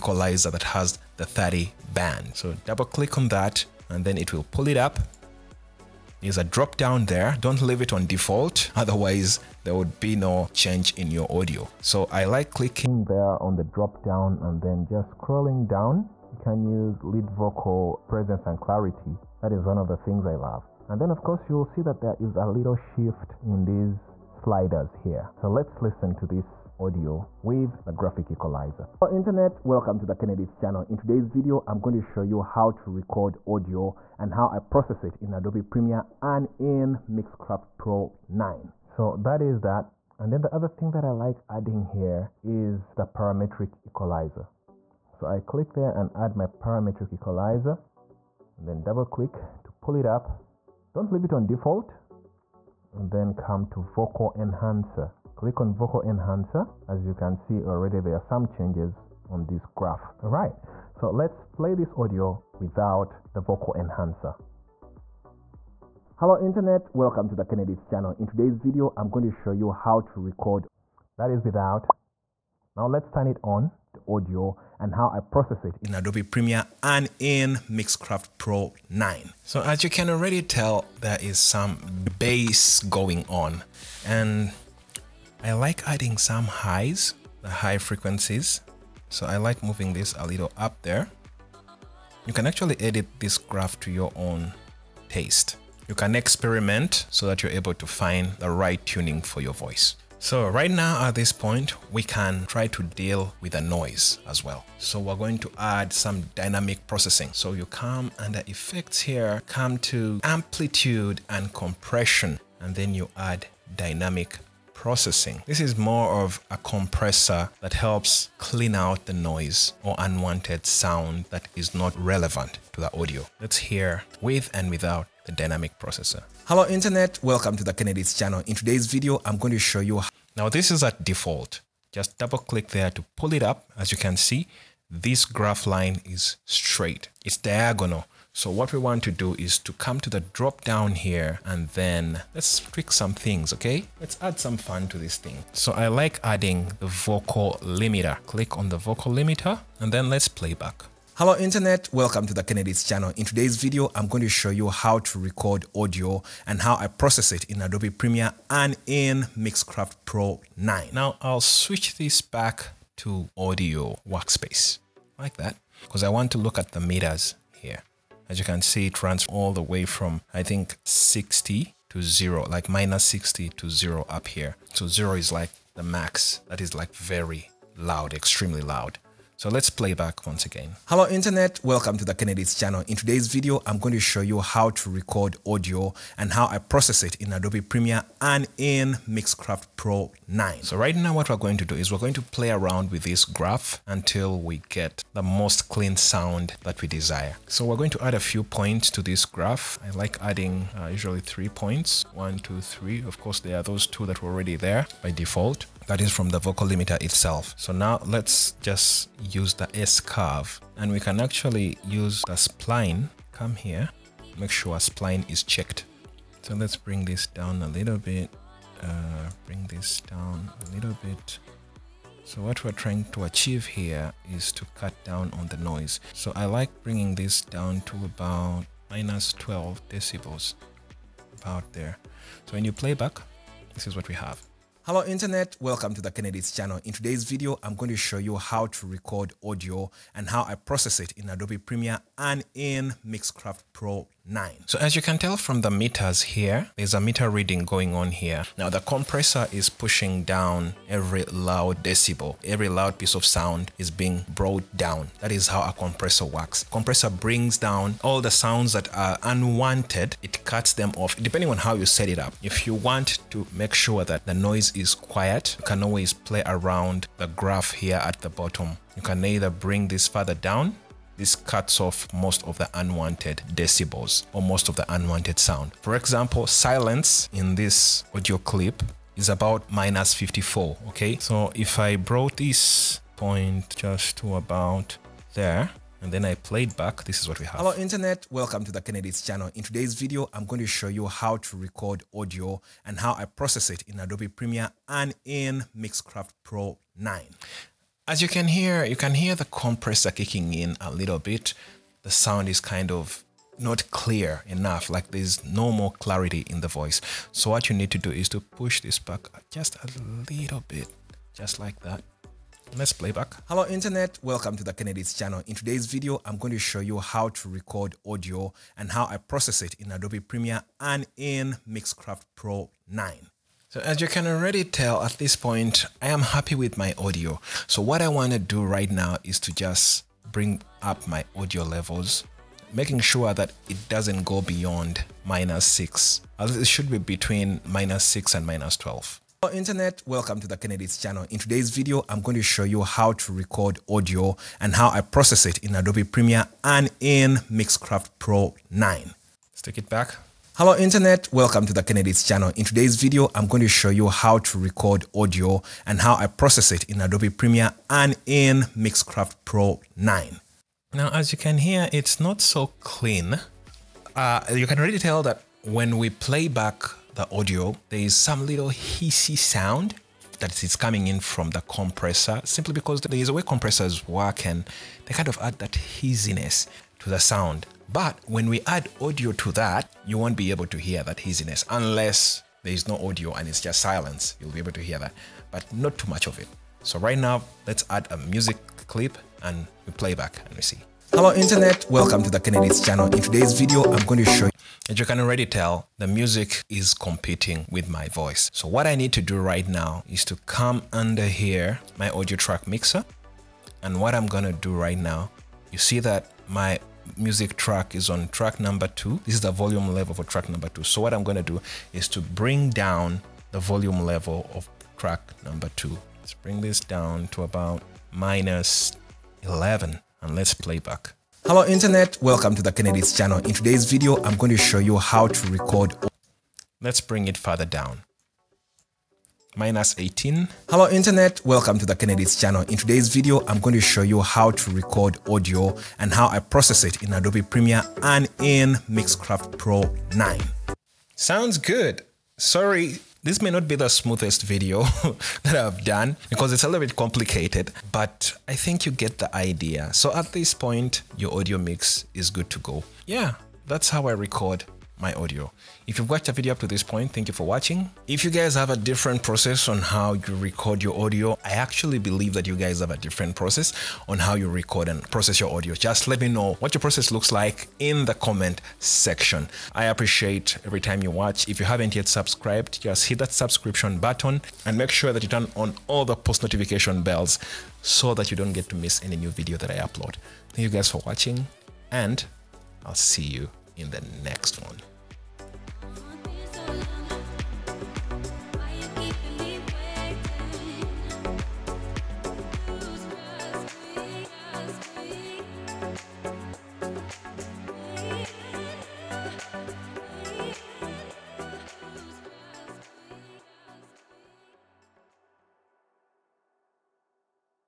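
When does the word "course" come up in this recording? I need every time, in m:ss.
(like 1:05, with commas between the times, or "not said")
0:21, 3:23.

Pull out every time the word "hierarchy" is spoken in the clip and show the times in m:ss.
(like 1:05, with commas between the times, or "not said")
not said.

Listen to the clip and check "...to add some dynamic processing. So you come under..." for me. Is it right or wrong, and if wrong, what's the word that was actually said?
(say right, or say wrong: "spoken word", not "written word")
right.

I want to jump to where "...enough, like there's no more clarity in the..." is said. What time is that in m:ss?
5:04.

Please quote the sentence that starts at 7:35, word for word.
If you've watched the video up to this point, thank you for watching.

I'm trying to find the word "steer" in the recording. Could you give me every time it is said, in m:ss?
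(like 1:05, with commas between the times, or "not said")
not said.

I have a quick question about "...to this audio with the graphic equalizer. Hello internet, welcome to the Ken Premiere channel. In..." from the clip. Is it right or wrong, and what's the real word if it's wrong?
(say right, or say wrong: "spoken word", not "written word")
wrong: "Edits", not "Premiere".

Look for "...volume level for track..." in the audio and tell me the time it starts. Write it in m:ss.
6:49.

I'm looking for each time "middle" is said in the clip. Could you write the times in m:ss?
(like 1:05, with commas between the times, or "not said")
not said.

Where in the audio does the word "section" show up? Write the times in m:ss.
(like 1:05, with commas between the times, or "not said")
7:48.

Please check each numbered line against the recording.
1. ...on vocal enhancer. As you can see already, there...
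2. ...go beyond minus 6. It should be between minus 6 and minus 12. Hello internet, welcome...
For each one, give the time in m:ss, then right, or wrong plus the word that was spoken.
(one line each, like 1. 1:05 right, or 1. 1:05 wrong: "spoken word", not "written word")
1. 0:55 right
2. 5:34 right.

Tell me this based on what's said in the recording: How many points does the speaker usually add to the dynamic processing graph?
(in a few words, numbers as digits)
3.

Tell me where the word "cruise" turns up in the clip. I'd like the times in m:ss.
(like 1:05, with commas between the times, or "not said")
not said.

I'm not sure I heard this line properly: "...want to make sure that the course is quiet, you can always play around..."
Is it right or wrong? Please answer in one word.
wrong.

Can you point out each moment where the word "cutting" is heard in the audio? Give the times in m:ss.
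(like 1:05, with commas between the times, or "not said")
not said.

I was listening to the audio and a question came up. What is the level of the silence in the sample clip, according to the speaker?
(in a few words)
-54.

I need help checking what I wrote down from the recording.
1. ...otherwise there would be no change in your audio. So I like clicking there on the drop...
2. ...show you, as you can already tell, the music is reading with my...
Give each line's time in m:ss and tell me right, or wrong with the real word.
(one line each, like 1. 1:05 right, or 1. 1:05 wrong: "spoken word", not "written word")
1. 0:08 right
2. 6:34 wrong: "competing", not "reading".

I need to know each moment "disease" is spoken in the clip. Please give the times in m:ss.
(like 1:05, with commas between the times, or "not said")
not said.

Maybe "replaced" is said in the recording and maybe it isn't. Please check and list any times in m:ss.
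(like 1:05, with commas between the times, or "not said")
not said.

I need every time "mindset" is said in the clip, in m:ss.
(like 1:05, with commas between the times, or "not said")
not said.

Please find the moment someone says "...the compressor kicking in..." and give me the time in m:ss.
4:59.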